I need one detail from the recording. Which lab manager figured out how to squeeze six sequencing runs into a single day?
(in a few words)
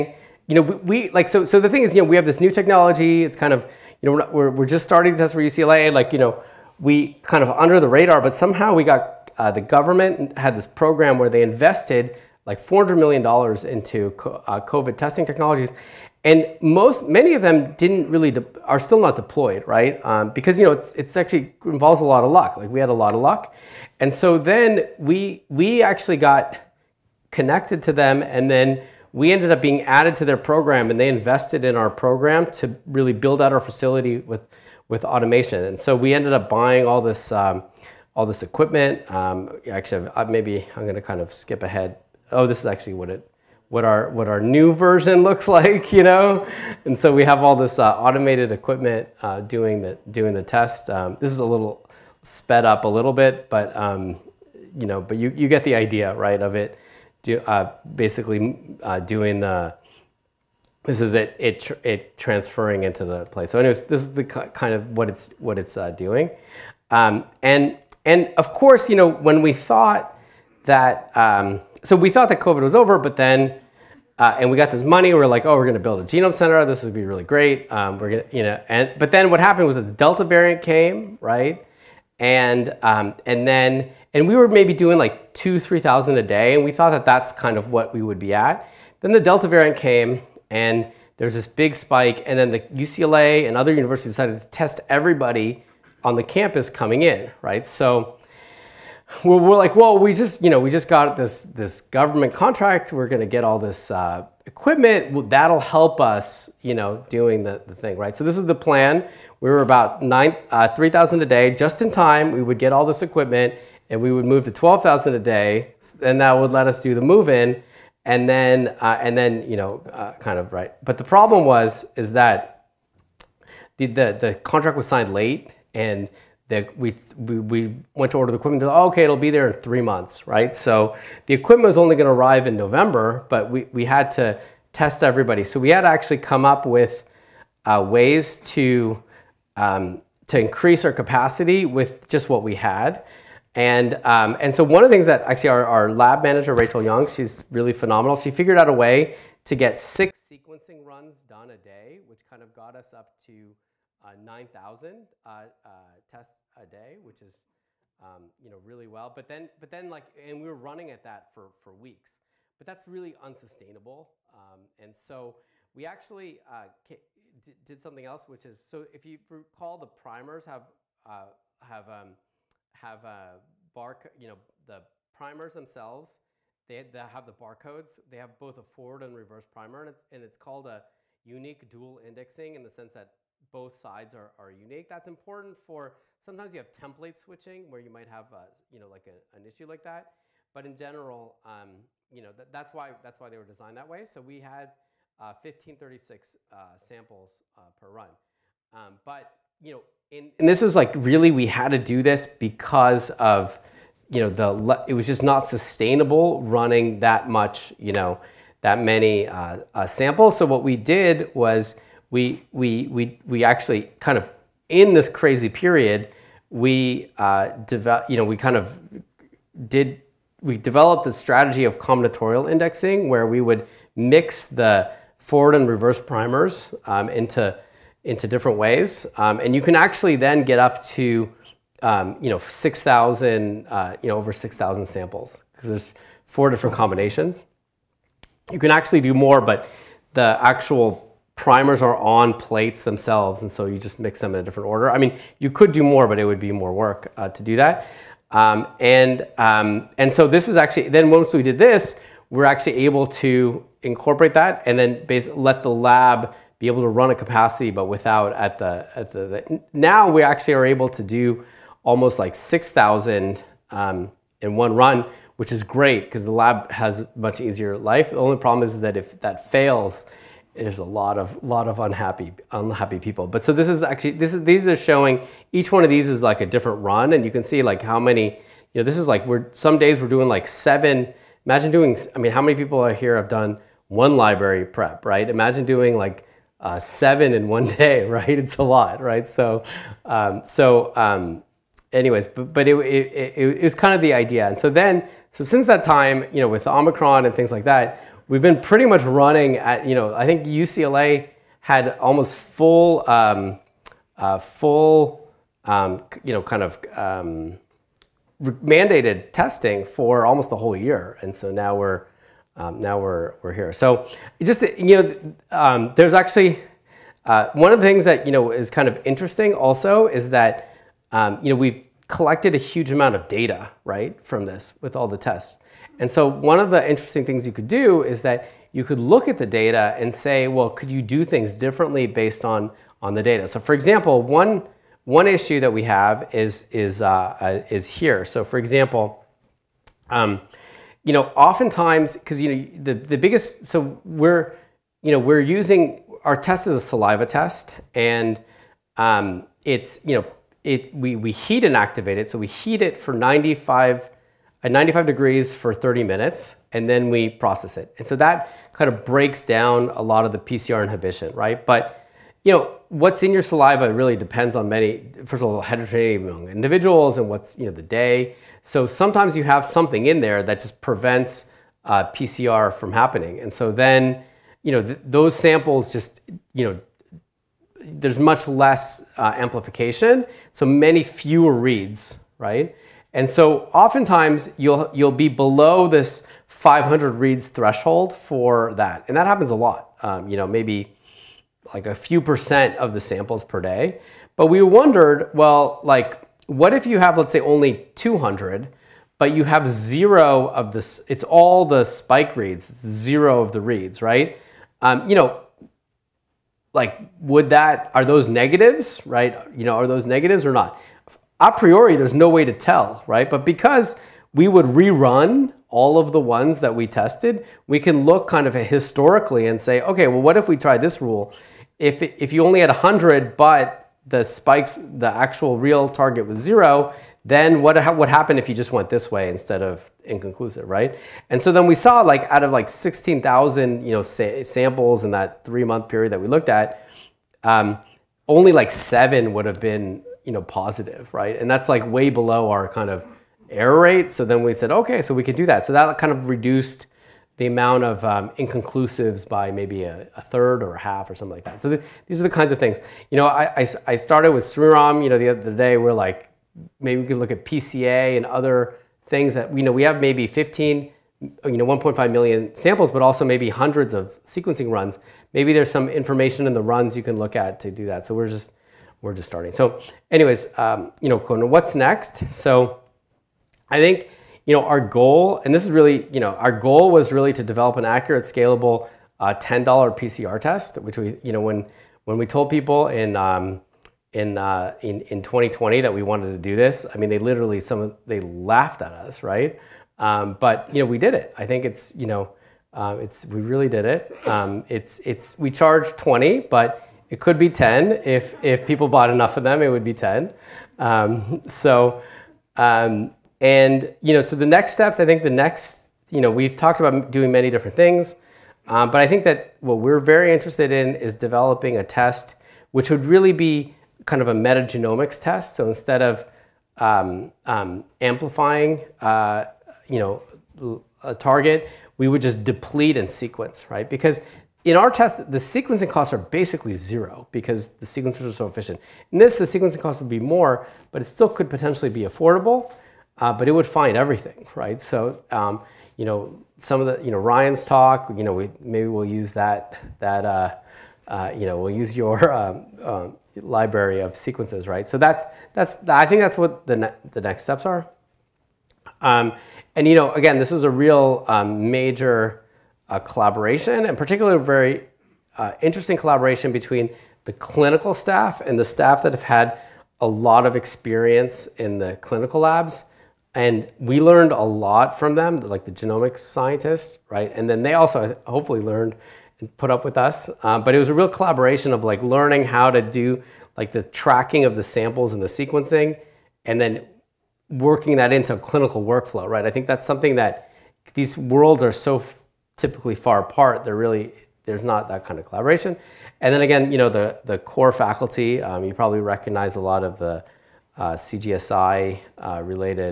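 Rachel Young.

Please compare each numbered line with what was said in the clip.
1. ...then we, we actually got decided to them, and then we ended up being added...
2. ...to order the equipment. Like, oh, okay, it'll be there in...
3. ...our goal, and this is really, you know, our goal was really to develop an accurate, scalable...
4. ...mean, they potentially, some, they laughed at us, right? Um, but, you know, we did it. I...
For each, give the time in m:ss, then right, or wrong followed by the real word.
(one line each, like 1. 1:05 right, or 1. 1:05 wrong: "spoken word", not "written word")
1. 0:24 wrong: "connected", not "decided"
2. 2:08 right
3. 7:54 right
4. 8:06 wrong: "literally", not "potentially".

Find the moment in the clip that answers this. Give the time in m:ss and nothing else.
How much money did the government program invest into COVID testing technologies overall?
0:12.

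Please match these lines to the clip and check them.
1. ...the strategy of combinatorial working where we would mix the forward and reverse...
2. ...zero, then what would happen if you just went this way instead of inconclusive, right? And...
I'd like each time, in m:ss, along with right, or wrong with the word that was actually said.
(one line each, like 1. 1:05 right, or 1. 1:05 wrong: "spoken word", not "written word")
1. 3:41 wrong: "indexing", not "working"
2. 7:06 right.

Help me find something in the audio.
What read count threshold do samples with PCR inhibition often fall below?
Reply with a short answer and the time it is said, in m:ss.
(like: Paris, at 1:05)
500, at 6:26.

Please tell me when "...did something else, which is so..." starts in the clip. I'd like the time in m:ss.
2:46.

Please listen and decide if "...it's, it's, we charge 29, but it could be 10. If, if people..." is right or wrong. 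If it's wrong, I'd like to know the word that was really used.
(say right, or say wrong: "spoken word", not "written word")
wrong: "20", not "29".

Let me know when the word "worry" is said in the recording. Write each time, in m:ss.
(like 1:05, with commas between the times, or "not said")
not said.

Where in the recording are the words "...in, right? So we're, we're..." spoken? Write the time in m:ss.
1:37.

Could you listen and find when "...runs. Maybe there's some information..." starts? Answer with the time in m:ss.
7:44.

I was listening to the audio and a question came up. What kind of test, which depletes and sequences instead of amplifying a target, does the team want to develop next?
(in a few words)
metagenomics test.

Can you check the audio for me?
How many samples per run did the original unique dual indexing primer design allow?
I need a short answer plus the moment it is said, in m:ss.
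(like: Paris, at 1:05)
1536, at 3:15.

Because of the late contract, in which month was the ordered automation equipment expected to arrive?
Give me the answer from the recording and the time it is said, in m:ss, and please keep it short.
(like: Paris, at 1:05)
November, at 2:12.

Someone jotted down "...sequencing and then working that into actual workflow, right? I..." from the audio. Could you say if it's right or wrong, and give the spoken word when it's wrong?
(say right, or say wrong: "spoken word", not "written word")
wrong: "clinical", not "actual".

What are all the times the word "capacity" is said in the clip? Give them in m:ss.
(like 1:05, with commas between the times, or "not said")
2:20, 4:17.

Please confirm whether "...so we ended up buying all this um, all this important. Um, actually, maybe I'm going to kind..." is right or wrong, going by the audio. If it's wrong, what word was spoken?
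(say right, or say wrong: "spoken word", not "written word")
wrong: "equipment", not "important".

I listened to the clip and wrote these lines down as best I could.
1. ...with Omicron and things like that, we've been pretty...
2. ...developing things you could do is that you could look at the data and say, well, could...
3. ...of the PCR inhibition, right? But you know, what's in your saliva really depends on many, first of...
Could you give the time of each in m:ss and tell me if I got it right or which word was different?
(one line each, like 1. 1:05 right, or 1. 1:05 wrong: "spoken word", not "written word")
1. 4:56 right
2. 5:26 wrong: "interesting", not "developing"
3. 6:00 right.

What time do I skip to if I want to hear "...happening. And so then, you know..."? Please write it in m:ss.
6:12.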